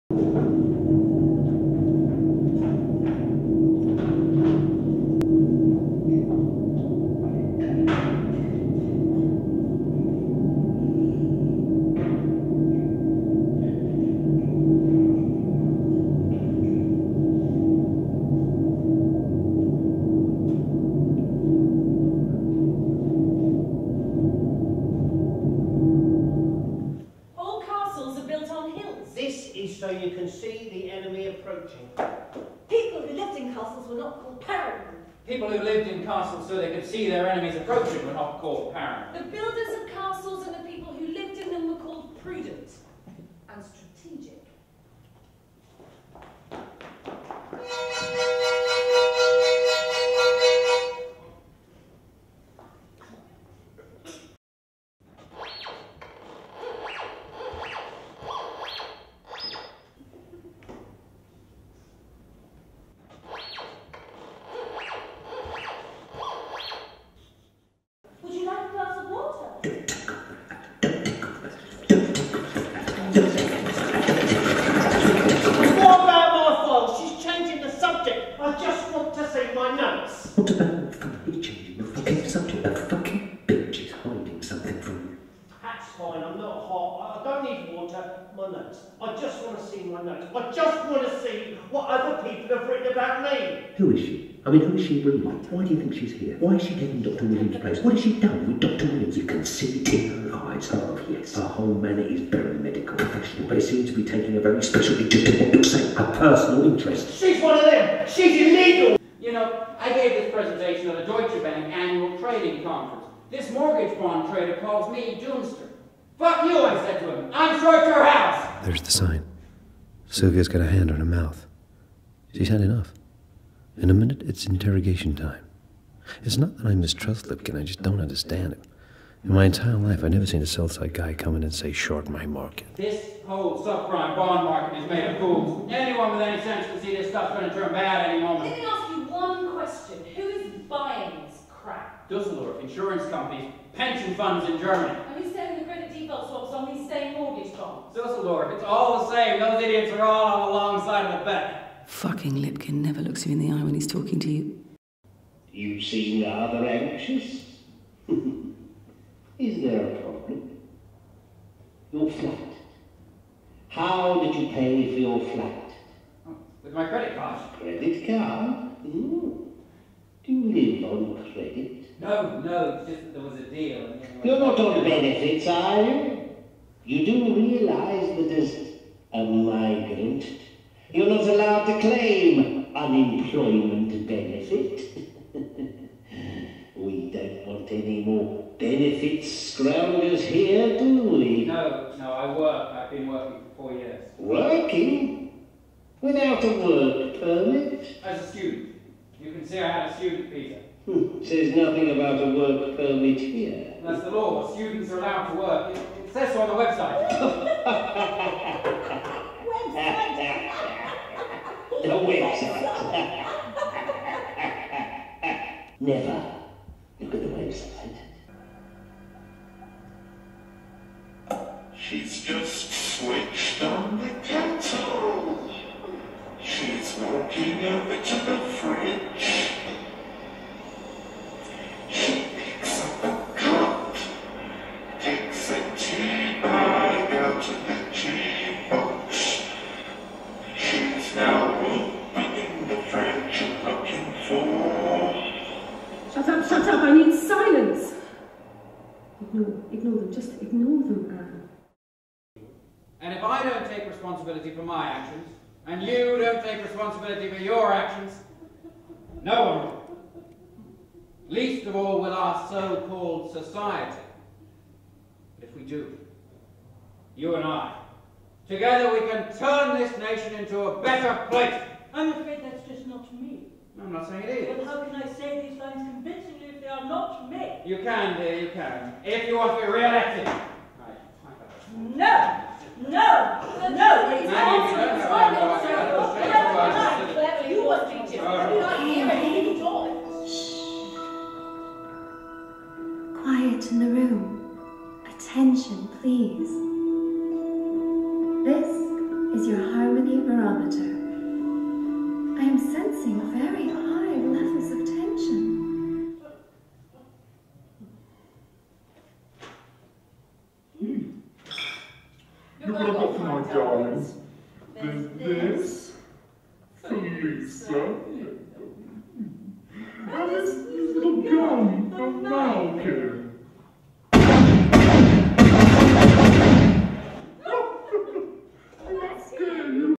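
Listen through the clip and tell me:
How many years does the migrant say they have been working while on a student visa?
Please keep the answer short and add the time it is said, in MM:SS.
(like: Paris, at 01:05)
4, at 03:13.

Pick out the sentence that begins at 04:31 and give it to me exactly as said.
I'm afraid that's just not me.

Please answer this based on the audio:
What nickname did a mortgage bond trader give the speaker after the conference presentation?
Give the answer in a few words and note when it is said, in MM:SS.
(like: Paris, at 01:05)
Doomster, at 01:55.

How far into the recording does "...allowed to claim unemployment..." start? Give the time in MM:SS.
03:01.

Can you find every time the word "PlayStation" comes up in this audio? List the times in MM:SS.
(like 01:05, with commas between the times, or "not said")
not said.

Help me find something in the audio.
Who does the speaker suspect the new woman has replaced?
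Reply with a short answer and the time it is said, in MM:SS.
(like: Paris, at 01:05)
Dr. Williams, at 01:38.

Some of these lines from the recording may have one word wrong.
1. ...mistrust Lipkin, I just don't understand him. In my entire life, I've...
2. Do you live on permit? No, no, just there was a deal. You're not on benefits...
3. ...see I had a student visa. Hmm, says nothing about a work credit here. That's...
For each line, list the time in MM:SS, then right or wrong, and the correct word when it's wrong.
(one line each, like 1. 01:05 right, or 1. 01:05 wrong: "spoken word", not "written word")
1. 02:06 right
2. 02:50 wrong: "credit", not "permit"
3. 03:19 wrong: "permit", not "credit".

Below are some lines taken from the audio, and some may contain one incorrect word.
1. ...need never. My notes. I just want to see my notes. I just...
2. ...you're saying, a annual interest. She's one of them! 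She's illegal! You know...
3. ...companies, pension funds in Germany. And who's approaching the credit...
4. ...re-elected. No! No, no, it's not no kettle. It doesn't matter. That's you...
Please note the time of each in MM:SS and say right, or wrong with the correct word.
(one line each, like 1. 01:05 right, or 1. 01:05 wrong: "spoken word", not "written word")
1. 01:27 wrong: "water", not "never"
2. 01:45 wrong: "personal", not "annual"
3. 02:23 wrong: "selling", not "approaching"
4. 04:39 wrong: "circle", not "kettle".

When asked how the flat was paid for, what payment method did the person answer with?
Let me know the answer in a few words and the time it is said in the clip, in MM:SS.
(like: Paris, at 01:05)
Credit card, at 02:46.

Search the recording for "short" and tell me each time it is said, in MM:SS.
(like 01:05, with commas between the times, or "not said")
01:57, 02:11.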